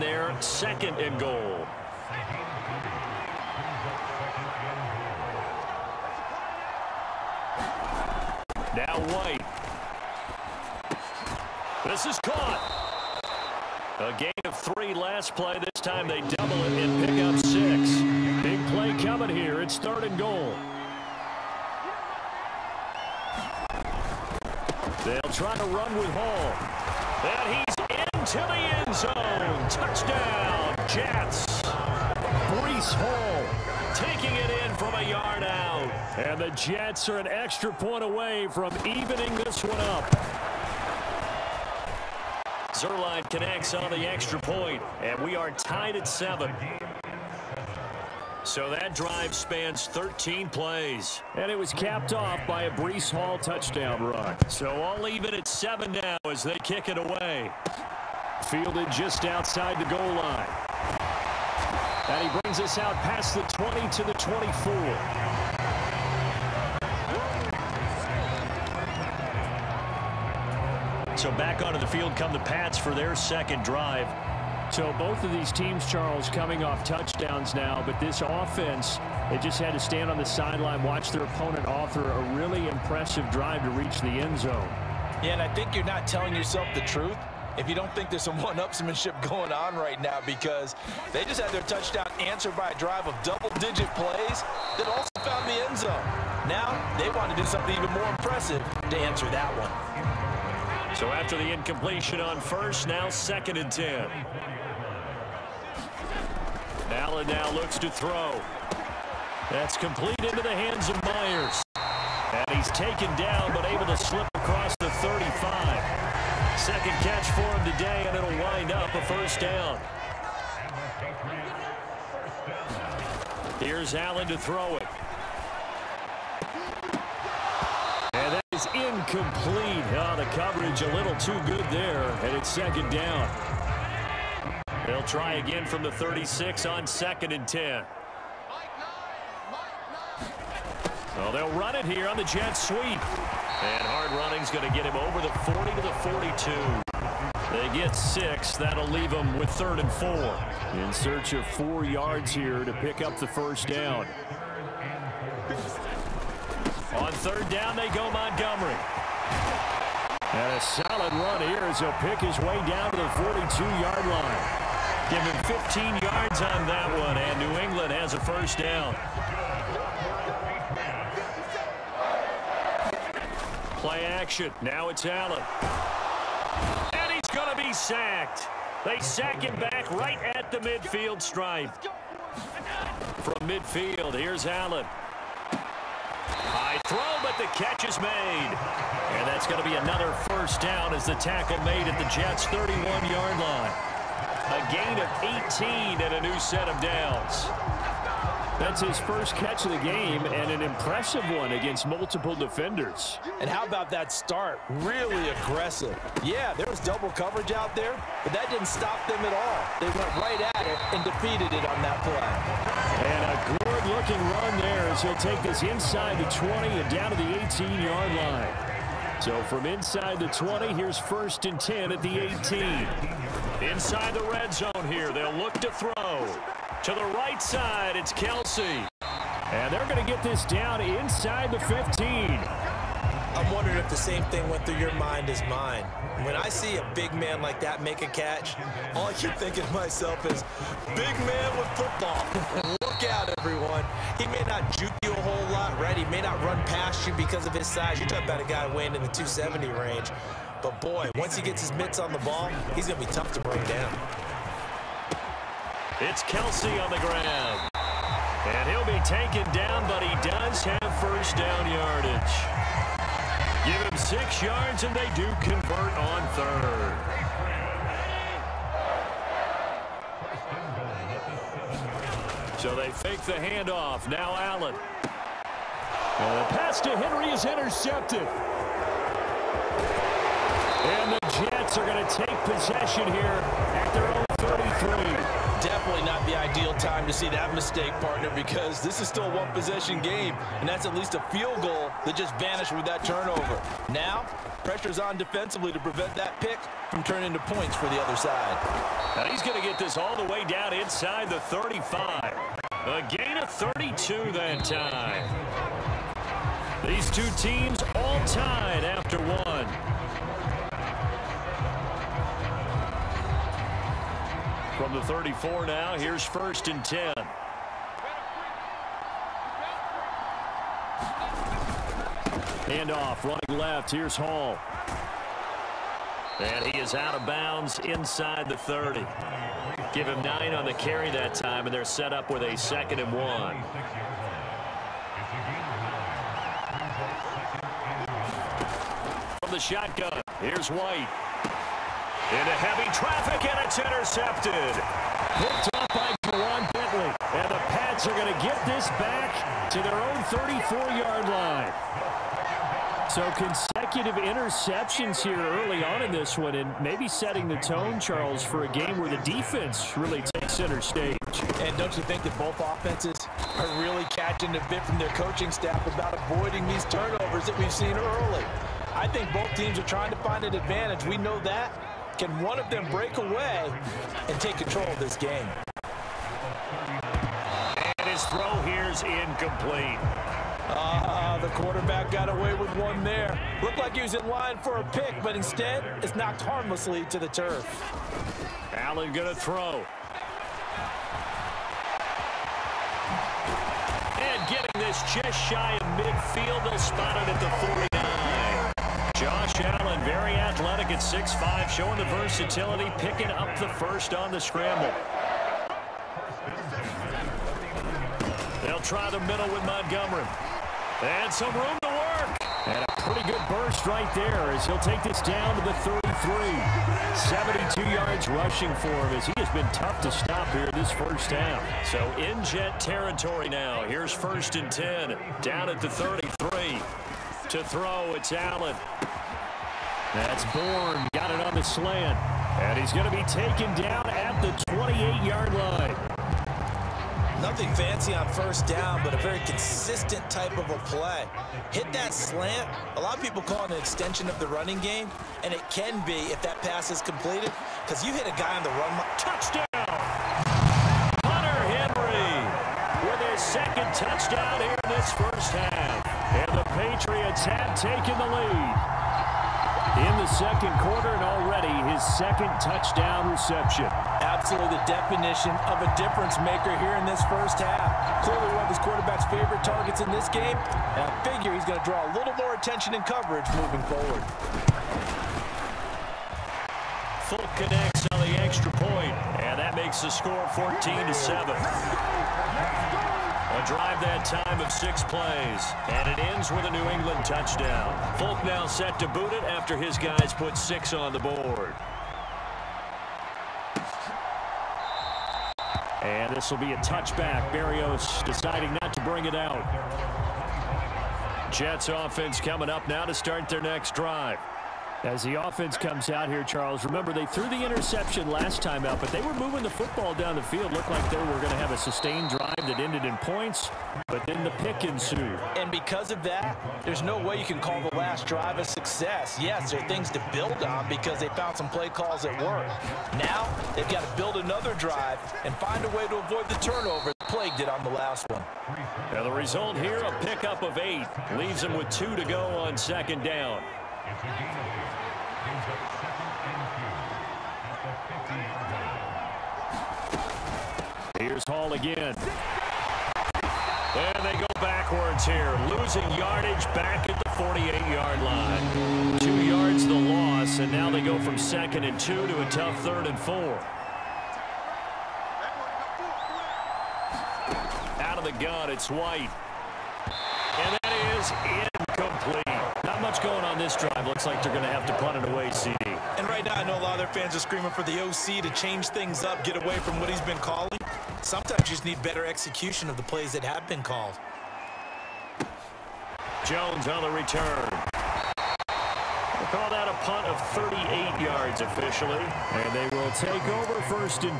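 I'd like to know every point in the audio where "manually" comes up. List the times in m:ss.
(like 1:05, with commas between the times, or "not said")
not said.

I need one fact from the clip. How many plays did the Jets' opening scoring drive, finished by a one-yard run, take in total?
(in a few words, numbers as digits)
13.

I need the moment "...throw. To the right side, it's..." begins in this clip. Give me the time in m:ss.
3:45.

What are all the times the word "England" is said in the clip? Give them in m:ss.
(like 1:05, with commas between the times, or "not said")
2:47, 8:06.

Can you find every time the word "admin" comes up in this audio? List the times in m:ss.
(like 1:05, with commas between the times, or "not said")
not said.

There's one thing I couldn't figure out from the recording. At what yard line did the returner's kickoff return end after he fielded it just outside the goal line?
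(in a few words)
24.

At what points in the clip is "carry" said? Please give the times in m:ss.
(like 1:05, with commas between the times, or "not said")
5:30.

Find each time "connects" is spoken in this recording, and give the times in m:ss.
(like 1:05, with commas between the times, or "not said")
0:43, 7:57.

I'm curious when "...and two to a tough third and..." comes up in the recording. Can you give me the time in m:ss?
9:11.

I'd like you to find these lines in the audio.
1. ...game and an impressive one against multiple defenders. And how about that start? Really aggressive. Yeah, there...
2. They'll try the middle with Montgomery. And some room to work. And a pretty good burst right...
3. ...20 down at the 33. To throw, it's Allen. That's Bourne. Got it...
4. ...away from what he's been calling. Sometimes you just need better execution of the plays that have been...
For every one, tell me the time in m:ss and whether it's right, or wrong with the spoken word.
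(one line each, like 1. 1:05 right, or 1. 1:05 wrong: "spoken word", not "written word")
1. 3:19 right
2. 6:48 right
3. 7:04 wrong: "10", not "20"
4. 9:29 right.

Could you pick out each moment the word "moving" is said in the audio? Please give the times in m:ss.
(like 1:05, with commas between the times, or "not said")
7:53, 8:29.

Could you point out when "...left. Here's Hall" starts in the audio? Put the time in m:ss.
5:23.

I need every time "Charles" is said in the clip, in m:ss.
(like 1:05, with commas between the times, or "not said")
1:15, 5:57, 8:26.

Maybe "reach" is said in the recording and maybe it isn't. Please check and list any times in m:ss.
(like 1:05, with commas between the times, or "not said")
1:23.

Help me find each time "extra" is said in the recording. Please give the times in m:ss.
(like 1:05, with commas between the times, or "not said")
0:37, 0:44, 7:58.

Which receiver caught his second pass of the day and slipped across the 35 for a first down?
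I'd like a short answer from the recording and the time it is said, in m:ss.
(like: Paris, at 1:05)
Meyers, at 1:51.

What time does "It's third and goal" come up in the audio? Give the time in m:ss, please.
0:19.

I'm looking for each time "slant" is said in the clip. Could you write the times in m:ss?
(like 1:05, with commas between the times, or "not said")
7:11, 7:22.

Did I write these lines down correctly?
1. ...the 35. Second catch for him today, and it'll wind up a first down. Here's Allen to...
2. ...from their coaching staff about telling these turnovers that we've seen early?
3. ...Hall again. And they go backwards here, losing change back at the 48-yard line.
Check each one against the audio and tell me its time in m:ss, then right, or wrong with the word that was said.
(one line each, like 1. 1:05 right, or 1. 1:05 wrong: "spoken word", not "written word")
1. 1:54 right
2. 6:04 wrong: "avoiding", not "telling"
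3. 9:01 wrong: "yardage", not "change".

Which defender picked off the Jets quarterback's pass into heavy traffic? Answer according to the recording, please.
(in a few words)
Ja'Whaun Bentley.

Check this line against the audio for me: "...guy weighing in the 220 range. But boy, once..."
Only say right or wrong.
wrong.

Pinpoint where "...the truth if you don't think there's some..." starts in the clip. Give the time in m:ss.
1:26.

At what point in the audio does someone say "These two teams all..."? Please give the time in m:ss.
5:06.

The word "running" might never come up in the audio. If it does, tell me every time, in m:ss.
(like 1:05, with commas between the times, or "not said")
2:24, 5:23, 7:24.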